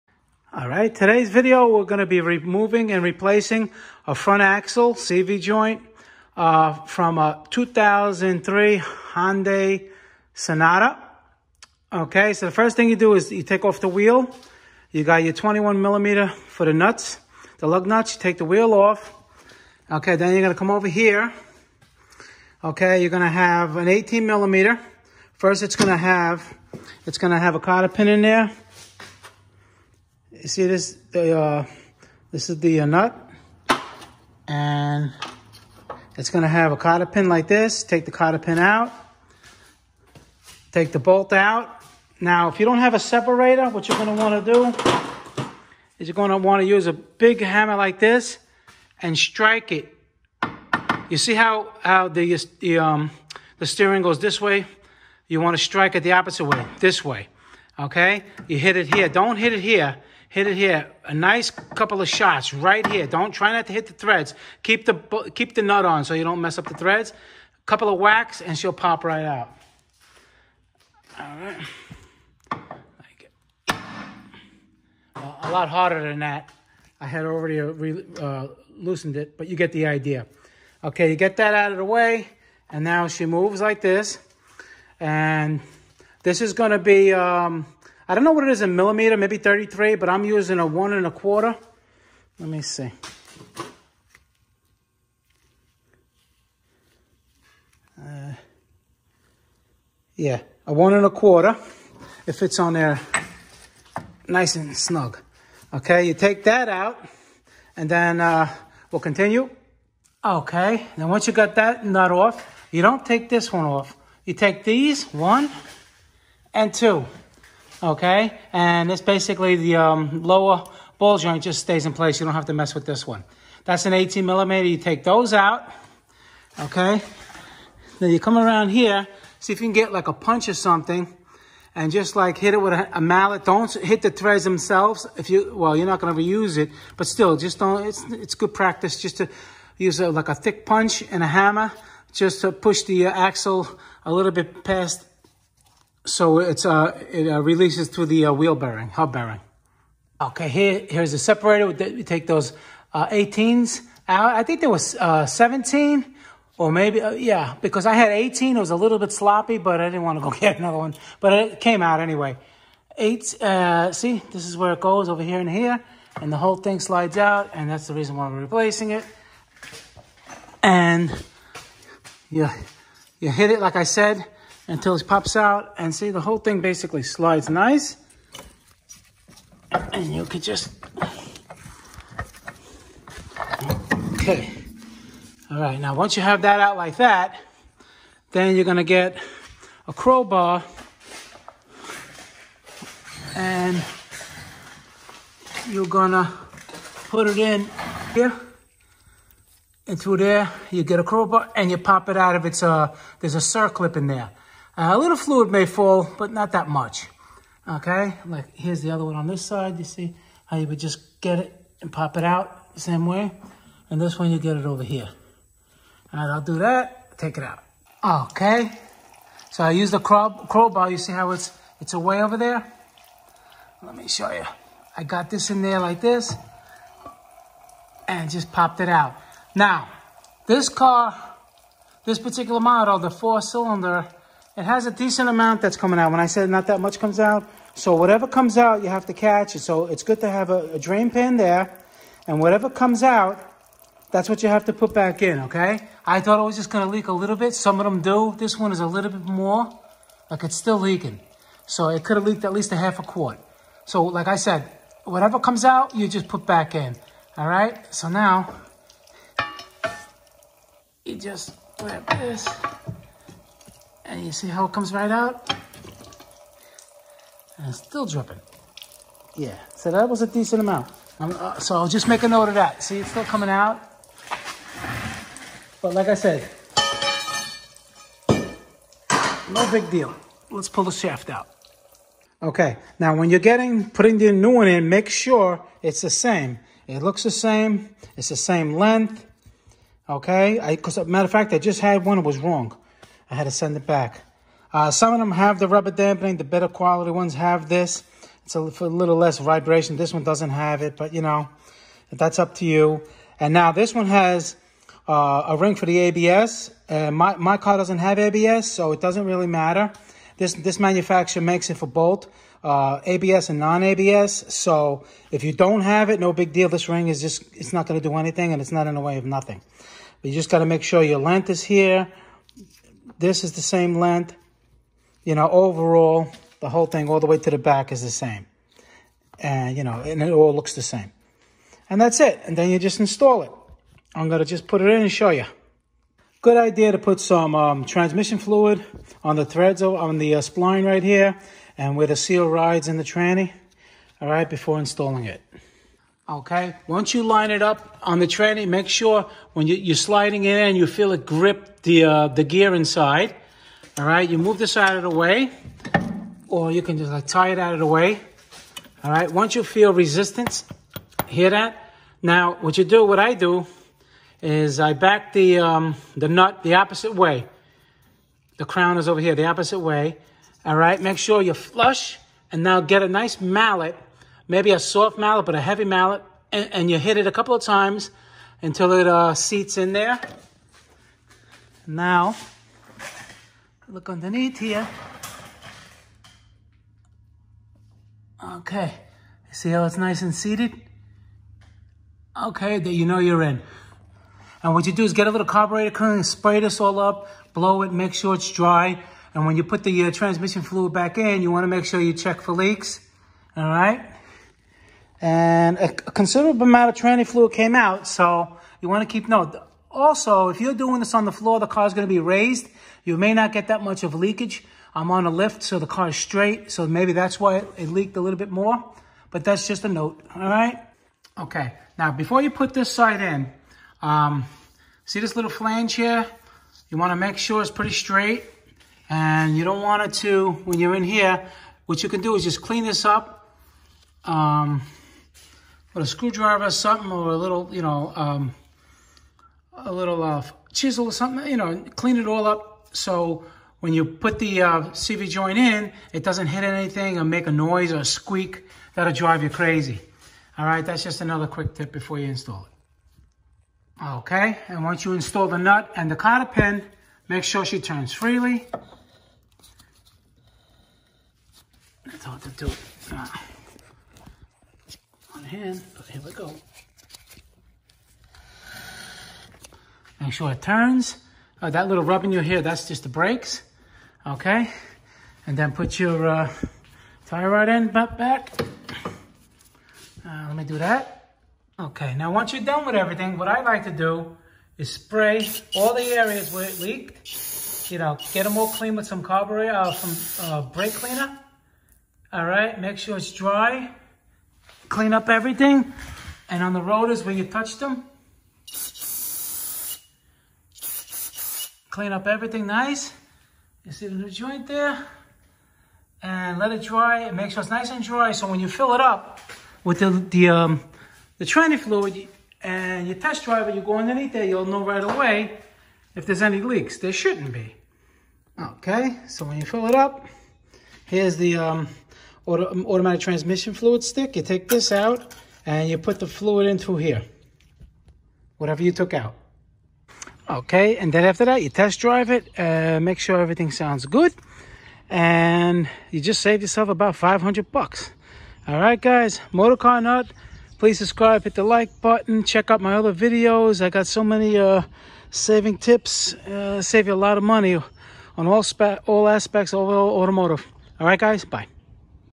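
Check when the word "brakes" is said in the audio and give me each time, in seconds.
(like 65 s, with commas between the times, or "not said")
473 s, 490 s.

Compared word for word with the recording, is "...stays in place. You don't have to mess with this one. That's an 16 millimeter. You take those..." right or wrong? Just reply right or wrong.
wrong.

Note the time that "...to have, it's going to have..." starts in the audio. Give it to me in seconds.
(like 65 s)
25 s.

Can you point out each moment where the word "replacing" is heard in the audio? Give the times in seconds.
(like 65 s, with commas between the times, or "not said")
3 s, 168 s.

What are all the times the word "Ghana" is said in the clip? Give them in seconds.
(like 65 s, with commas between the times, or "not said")
not said.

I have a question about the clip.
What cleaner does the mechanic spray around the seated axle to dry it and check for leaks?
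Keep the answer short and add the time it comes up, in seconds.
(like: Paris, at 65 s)
carburetor cleaner, at 395 s.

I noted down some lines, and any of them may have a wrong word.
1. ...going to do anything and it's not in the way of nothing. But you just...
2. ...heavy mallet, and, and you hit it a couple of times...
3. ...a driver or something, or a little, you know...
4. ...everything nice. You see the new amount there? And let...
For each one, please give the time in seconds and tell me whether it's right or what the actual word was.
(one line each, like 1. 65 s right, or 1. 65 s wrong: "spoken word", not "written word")
1. 317 s right
2. 375 s right
3. 435 s wrong: "screwdriver", not "driver"
4. 502 s wrong: "joint", not "amount".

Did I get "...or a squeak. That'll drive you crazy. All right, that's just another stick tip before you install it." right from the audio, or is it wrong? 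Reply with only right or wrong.
wrong.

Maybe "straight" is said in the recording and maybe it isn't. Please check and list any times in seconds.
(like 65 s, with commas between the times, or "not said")
416 s, 427 s.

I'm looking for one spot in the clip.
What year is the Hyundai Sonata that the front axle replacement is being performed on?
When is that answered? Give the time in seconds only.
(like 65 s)
7 s.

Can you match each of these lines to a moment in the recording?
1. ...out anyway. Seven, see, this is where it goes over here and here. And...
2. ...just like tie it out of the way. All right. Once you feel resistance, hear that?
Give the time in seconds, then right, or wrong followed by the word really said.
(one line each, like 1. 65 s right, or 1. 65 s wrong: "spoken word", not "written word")
1. 161 s wrong: "Eight", not "Seven"
2. 356 s right.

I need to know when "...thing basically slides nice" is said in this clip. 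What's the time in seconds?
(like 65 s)
176 s.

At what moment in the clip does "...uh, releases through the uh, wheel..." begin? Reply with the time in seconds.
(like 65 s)
147 s.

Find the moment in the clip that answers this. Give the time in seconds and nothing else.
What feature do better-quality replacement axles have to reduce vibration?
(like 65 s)
295 s.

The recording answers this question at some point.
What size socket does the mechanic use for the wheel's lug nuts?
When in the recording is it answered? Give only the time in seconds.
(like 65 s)
15 s.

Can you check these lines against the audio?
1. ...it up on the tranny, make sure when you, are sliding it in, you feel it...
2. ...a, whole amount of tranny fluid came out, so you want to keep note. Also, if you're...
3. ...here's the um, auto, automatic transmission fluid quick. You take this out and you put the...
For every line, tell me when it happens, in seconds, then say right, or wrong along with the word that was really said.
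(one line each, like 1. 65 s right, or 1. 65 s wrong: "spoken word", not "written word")
1. 347 s right
2. 405 s wrong: "considerable", not "whole"
3. 521 s wrong: "stick", not "quick".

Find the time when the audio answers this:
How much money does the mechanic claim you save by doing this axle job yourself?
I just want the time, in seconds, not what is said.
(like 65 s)
537 s.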